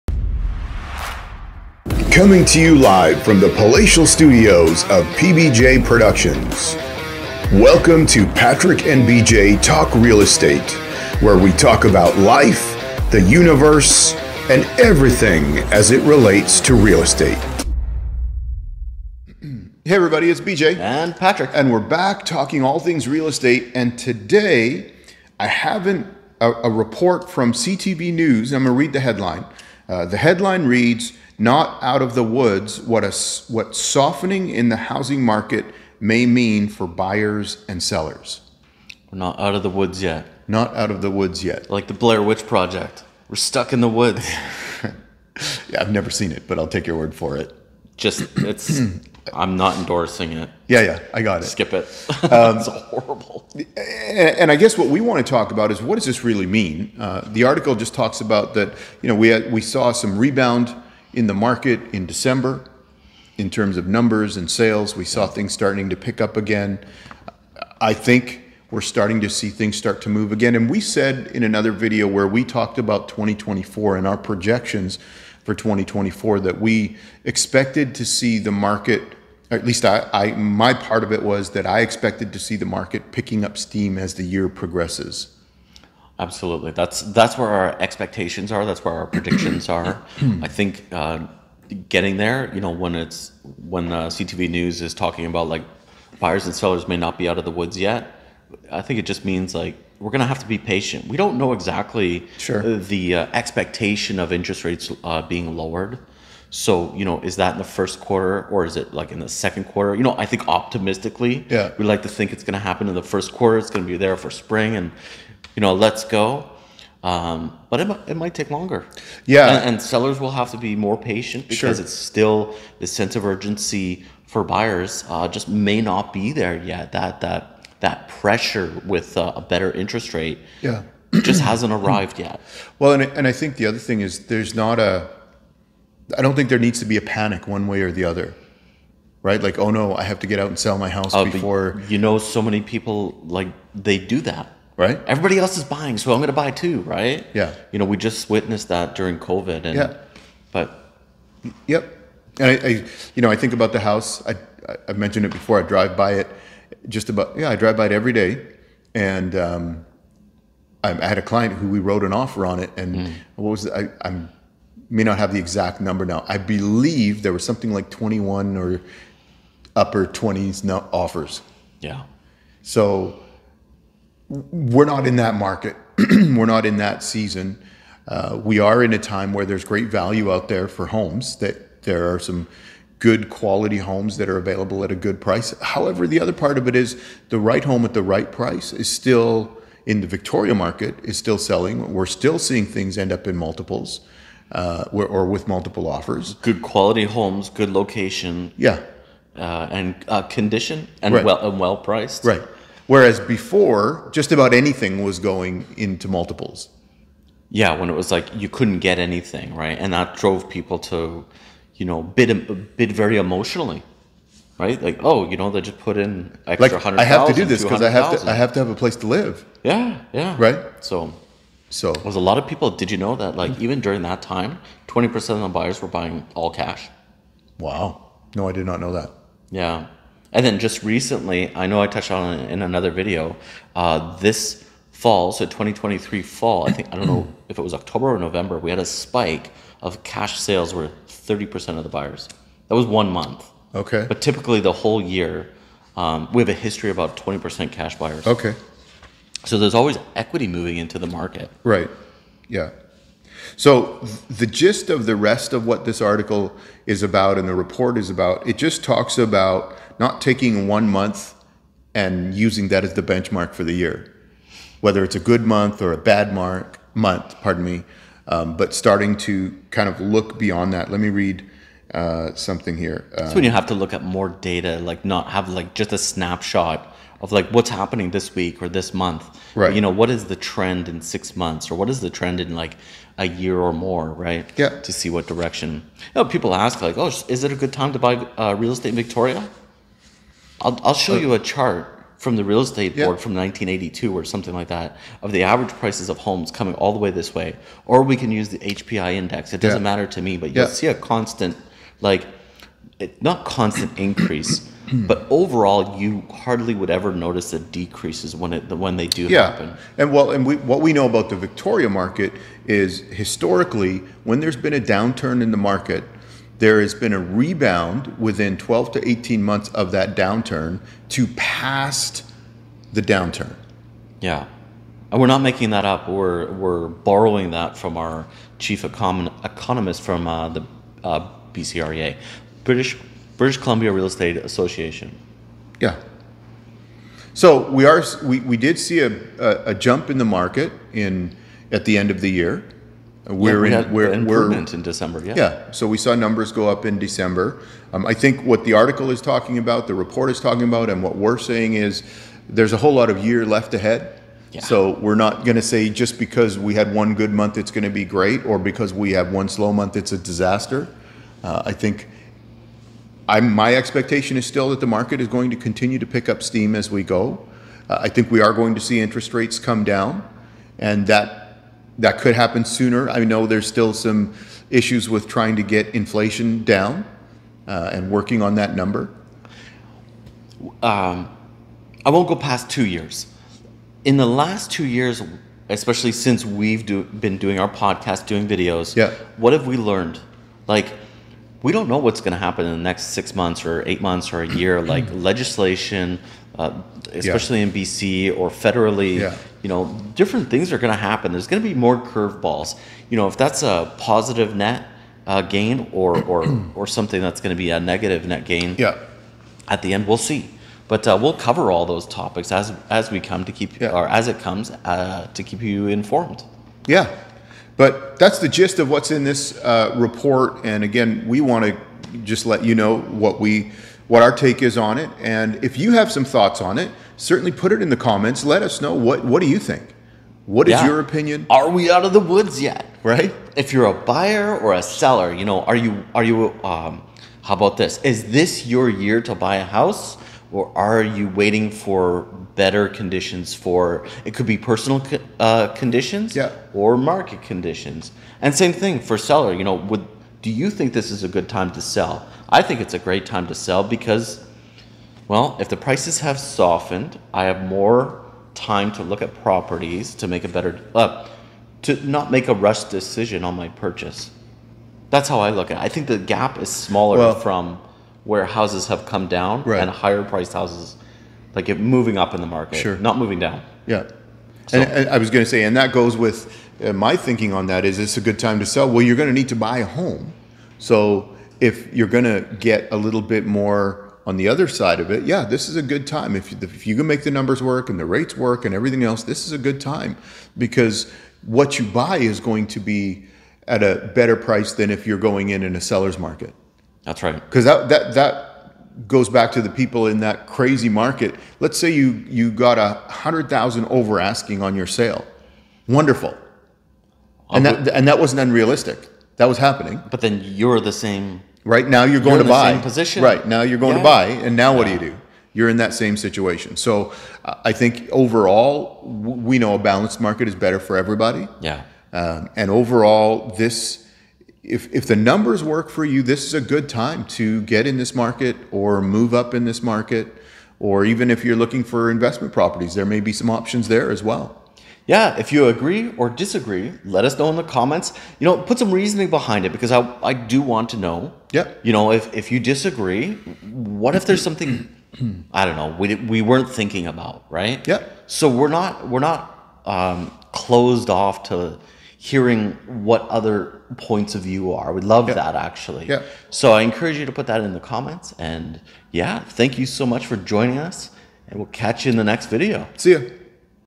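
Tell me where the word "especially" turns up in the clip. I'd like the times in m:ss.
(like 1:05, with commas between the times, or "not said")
6:25, 6:37.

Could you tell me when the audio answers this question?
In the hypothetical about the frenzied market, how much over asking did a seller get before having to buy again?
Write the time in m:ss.
8:22.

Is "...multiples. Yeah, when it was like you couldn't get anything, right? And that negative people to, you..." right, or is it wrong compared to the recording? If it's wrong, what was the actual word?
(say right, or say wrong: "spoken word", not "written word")
wrong: "drove", not "negative".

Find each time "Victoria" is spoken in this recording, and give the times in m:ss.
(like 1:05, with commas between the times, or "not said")
3:10, 4:48, 5:11.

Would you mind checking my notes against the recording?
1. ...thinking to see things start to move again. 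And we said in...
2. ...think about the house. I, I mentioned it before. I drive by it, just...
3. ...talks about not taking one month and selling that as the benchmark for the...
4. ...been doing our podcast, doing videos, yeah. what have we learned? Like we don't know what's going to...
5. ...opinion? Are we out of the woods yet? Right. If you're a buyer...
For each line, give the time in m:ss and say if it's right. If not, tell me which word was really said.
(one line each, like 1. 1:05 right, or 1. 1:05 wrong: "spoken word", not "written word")
1. 1:08 wrong: "starting", not "thinking"
2. 2:33 right
3. 4:18 wrong: "using", not "selling"
4. 6:27 right
5. 7:10 right.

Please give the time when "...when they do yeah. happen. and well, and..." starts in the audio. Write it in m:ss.
5:08.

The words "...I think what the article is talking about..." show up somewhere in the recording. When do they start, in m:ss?
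5:48.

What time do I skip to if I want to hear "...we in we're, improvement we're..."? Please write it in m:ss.
5:43.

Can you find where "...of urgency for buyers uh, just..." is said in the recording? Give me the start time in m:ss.
2:03.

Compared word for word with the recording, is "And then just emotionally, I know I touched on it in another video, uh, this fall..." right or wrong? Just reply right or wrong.
wrong.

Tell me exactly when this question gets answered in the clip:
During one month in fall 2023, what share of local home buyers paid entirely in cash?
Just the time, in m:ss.
4:01.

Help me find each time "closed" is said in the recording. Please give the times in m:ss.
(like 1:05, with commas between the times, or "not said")
9:10.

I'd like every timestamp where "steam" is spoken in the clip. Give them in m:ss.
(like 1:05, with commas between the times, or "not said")
1:23, 6:06.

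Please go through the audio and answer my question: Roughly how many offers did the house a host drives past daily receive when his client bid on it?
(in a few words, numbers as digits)
21.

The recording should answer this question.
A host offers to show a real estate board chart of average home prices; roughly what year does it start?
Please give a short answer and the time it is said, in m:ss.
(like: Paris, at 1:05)
1982, at 4:53.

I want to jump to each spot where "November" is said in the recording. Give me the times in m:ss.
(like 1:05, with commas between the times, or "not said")
3:58.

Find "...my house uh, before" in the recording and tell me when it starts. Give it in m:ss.
2:20.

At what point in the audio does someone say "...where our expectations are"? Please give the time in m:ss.
1:27.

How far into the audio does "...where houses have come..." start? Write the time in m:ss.
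7:48.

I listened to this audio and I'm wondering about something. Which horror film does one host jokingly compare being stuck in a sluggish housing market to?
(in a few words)
The Blair Witch Project.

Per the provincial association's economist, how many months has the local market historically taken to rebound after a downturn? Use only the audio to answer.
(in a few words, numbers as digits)
12 to 18 months.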